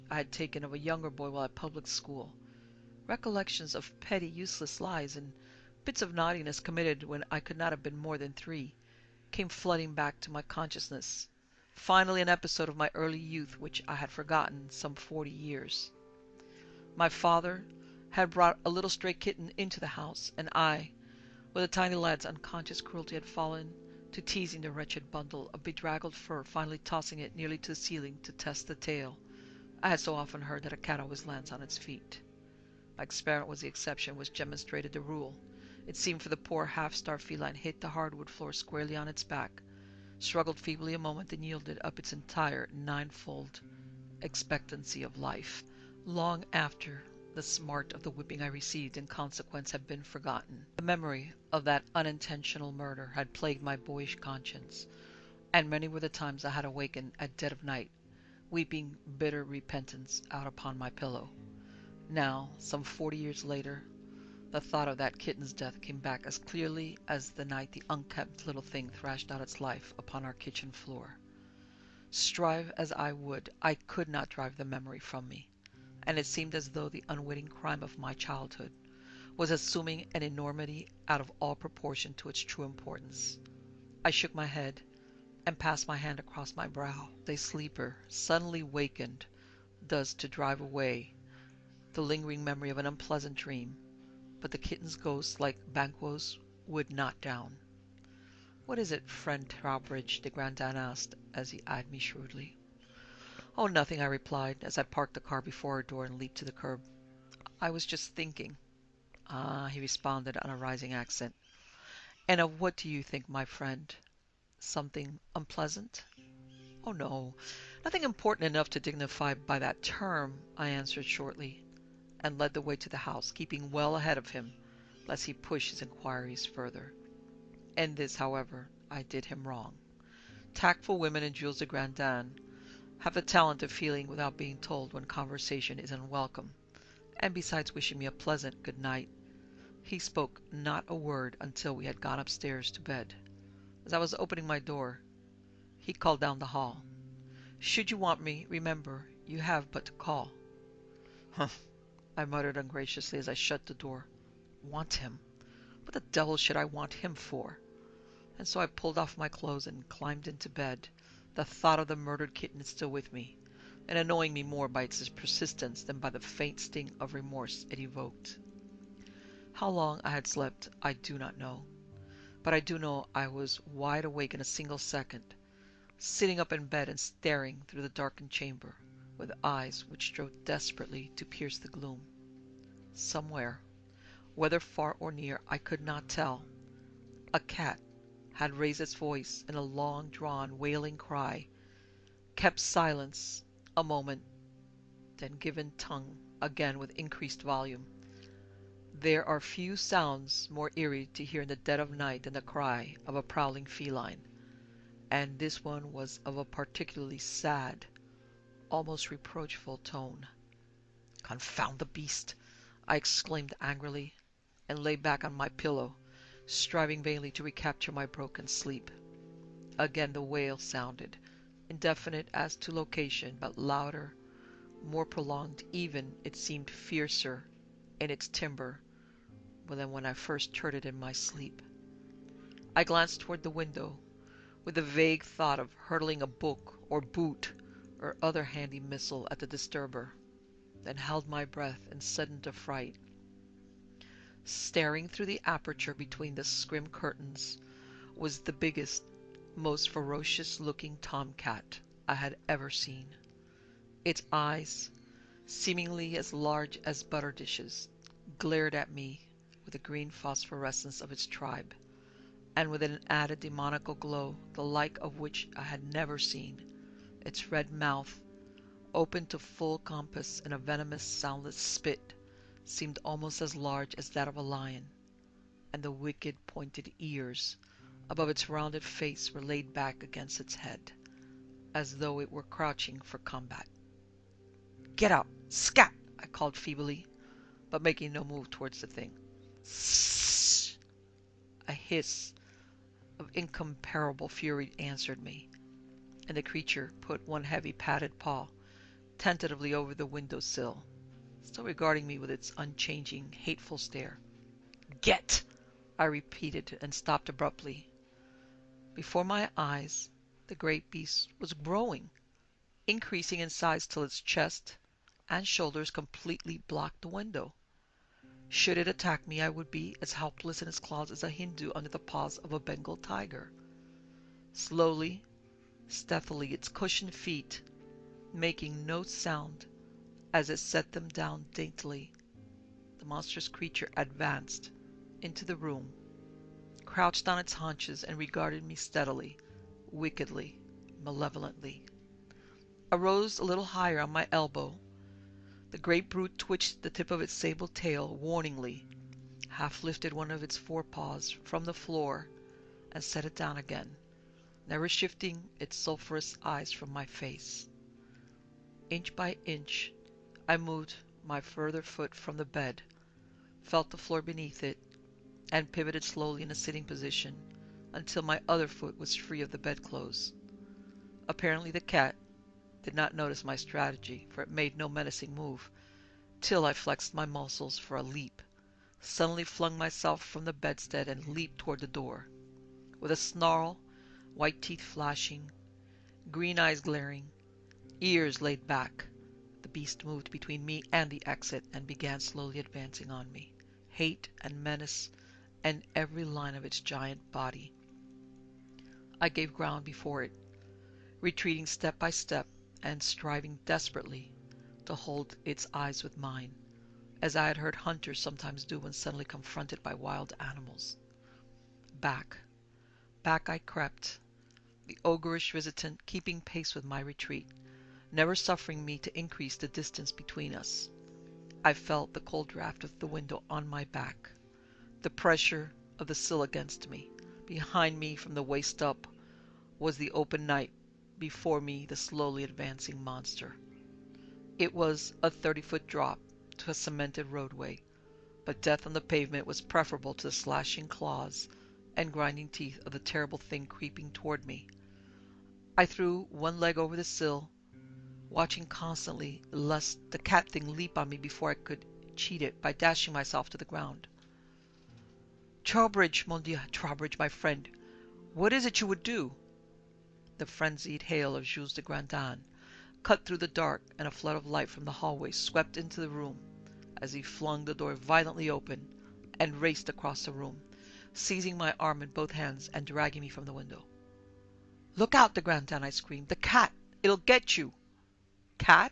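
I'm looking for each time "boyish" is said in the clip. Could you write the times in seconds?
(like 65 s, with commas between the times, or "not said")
53 s.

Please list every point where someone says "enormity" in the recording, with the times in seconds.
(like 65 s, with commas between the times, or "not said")
80 s.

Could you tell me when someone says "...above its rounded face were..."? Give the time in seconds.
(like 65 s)
278 s.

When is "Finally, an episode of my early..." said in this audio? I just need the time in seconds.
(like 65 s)
11 s.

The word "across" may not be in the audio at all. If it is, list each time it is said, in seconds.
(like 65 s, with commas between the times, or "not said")
86 s, 469 s.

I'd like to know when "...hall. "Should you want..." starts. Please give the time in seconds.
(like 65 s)
146 s.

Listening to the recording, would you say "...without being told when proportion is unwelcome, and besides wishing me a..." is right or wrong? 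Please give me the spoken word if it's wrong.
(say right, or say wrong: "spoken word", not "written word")
wrong: "conversation", not "proportion".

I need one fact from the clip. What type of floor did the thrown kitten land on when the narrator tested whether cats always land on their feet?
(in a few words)
hardwood floor.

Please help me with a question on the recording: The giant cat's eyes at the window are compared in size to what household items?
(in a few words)
butter dishes.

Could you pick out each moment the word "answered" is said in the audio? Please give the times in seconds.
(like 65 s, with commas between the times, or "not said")
120 s, 294 s.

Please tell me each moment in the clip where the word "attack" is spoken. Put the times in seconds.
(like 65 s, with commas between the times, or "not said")
318 s.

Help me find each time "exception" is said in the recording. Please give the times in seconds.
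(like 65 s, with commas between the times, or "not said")
33 s.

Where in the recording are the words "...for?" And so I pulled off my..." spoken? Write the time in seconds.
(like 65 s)
157 s.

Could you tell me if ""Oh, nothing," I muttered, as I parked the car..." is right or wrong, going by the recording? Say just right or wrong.
wrong.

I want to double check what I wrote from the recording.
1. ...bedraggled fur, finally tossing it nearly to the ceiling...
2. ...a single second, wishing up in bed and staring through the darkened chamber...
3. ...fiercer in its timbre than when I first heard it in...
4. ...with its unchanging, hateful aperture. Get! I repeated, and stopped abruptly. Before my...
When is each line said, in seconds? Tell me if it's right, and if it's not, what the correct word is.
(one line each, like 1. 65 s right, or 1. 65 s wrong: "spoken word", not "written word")
1. 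25 s right
2. 174 s wrong: "sitting", not "wishing"
3. 226 s right
4. 302 s wrong: "stare", not "aperture".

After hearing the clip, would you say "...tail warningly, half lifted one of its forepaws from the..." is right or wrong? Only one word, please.
right.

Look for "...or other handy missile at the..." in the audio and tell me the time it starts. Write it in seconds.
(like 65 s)
238 s.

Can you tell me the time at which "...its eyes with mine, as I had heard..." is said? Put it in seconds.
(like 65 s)
405 s.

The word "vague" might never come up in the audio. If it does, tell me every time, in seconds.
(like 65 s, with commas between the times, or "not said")
234 s.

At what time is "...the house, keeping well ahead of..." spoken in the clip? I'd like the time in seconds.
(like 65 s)
122 s.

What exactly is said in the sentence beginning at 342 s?
I rose a little higher on my elbow.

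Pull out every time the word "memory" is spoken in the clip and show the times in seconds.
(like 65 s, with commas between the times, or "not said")
50 s, 74 s, 92 s.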